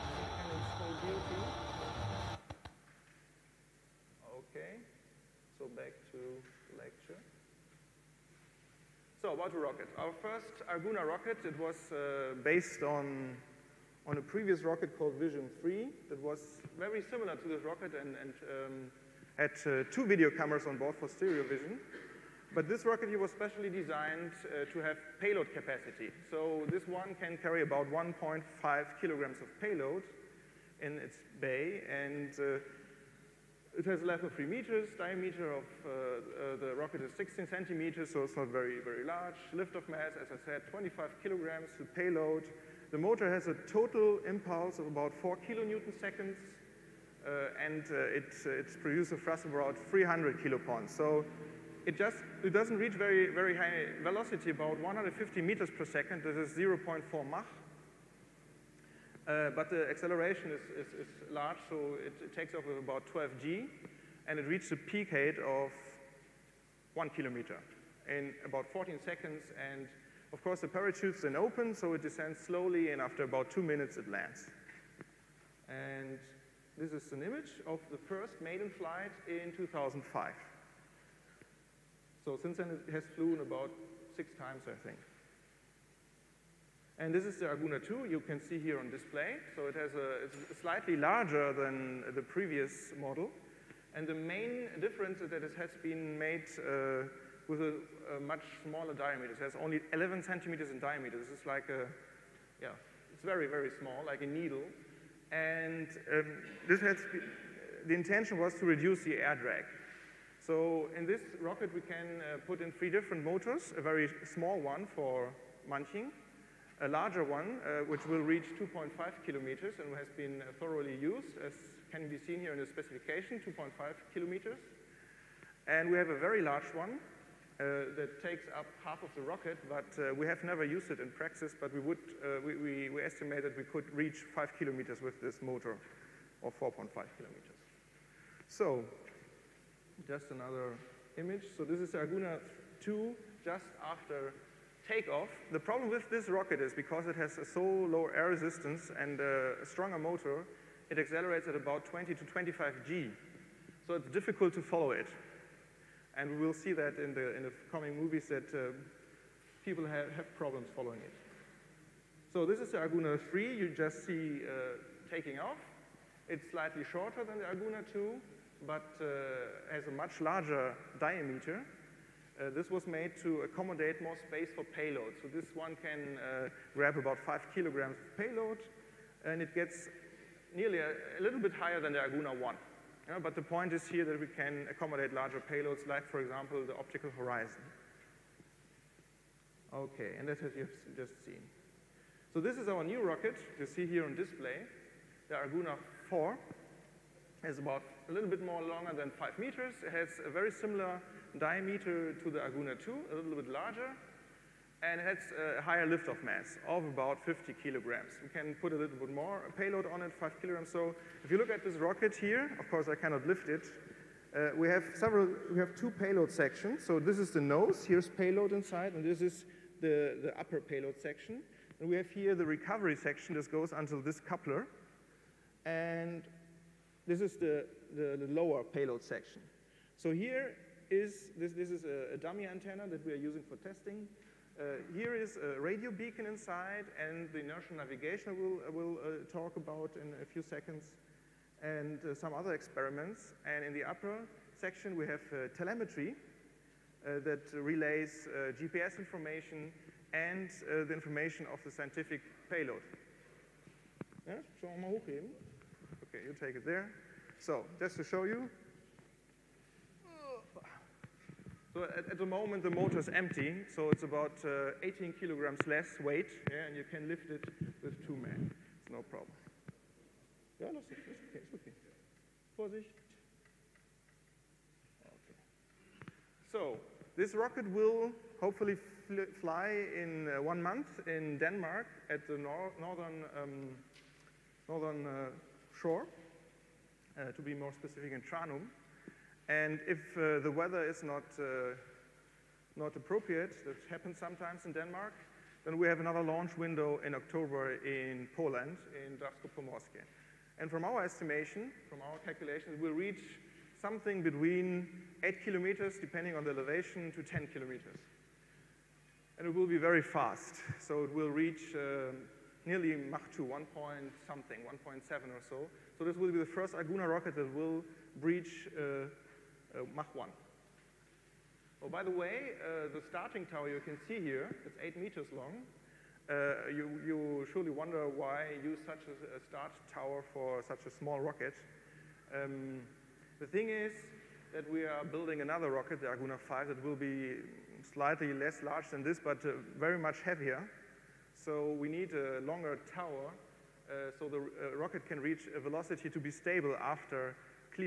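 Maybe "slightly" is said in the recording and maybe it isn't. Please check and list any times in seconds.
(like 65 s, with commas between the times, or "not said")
90 s, 166 s, 337 s.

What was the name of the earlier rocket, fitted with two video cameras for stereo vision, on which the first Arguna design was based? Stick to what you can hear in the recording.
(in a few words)
Vision 3.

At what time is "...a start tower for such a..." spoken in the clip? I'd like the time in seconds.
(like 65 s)
329 s.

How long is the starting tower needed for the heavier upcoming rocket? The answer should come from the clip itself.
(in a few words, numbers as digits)
8 meters.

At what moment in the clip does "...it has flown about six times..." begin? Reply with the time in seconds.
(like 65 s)
82 s.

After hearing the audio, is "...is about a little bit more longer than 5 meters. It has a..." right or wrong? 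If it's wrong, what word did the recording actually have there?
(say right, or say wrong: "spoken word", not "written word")
right.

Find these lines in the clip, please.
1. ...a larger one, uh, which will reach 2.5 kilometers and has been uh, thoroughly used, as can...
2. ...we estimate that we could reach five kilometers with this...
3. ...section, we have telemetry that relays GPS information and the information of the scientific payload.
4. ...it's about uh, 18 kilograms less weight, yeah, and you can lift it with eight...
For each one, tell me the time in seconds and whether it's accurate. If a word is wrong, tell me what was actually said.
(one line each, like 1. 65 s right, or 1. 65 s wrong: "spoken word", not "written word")
1. 116 s right
2. 132 s right
3. 244 s right
4. 263 s wrong: "two", not "eight".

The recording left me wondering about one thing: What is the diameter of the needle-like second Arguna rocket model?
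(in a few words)
11 centimeters.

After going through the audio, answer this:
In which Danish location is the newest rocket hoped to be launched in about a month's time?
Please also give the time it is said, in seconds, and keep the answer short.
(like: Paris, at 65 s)
Tranum, at 288 s.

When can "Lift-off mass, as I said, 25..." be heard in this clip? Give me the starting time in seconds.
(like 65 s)
39 s.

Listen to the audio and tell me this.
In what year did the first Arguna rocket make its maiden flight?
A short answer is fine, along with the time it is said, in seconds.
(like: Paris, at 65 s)
2005, at 79 s.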